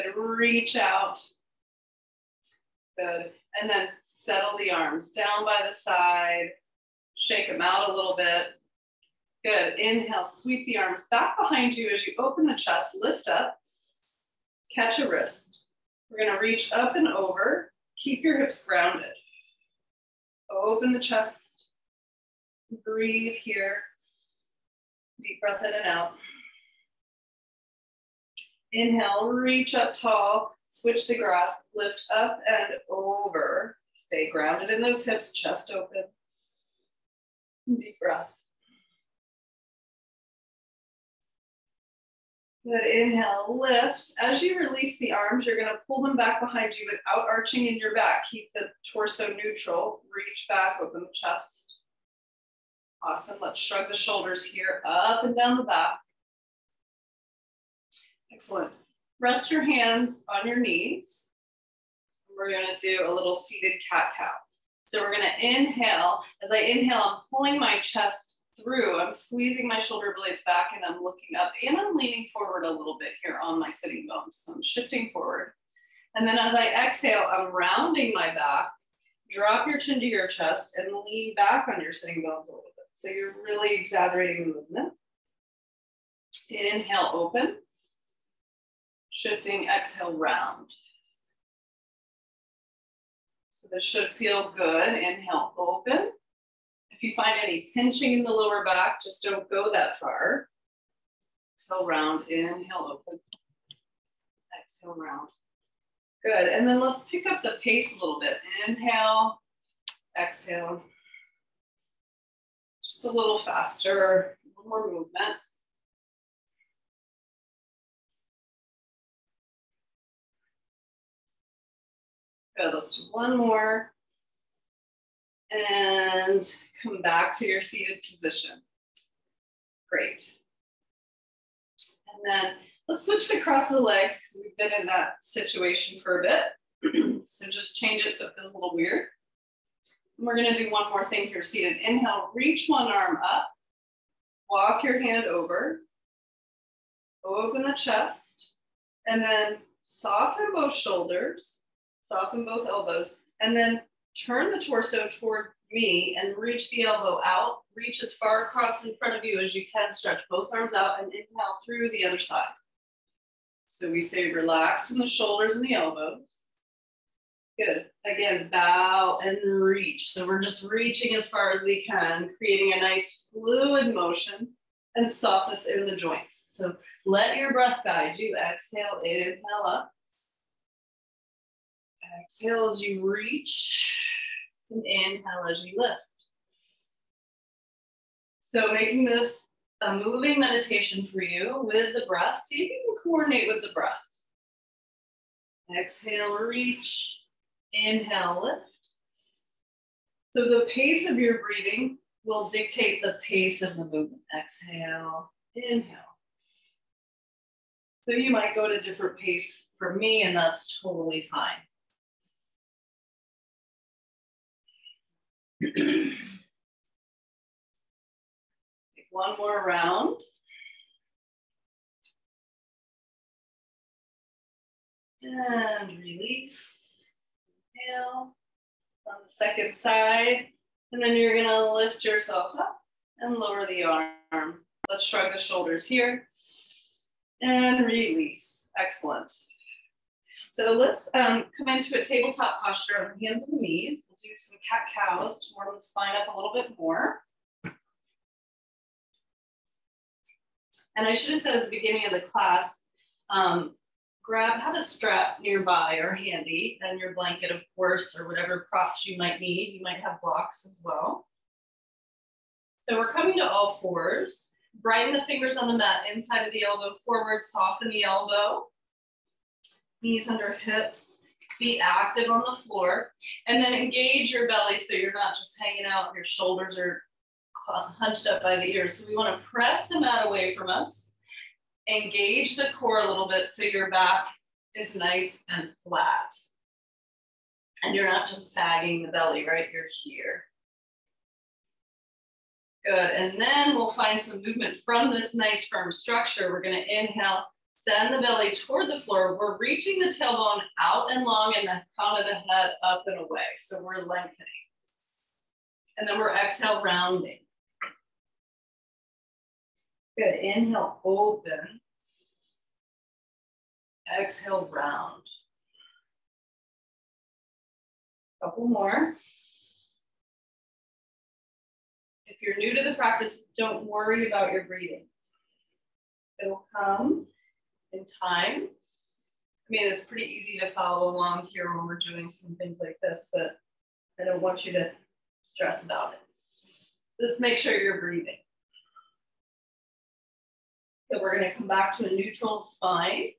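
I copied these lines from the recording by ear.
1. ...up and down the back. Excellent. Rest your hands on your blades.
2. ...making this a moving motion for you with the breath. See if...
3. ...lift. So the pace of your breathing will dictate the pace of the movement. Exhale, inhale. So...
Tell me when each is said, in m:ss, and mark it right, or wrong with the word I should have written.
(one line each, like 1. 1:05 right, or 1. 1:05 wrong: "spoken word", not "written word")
1. 0:54 wrong: "knees", not "blades"
2. 3:08 wrong: "meditation", not "motion"
3. 3:18 right.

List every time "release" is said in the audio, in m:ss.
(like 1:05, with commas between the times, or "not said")
0:44, 3:45, 3:57.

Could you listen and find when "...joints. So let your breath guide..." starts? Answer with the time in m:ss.
2:55.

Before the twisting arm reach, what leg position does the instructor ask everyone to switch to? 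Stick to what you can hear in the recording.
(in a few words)
Cross the legs.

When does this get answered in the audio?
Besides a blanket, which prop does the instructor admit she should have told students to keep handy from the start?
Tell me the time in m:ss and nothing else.
4:14.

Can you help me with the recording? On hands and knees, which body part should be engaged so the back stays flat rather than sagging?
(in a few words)
The core.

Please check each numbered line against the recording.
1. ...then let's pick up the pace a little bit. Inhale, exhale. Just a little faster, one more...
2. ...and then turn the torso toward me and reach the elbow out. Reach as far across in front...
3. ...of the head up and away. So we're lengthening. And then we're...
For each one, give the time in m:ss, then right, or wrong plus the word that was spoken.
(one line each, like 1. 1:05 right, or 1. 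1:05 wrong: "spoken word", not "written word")
1. 1:46 right
2. 2:33 right
3. 5:02 right.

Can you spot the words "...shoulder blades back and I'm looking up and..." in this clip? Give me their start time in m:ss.
1:09.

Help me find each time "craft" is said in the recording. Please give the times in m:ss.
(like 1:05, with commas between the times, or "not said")
not said.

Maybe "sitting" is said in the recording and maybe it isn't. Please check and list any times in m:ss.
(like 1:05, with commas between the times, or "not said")
1:13, 1:21.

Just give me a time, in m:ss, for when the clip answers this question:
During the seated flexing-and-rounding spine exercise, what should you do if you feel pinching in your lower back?
1:39.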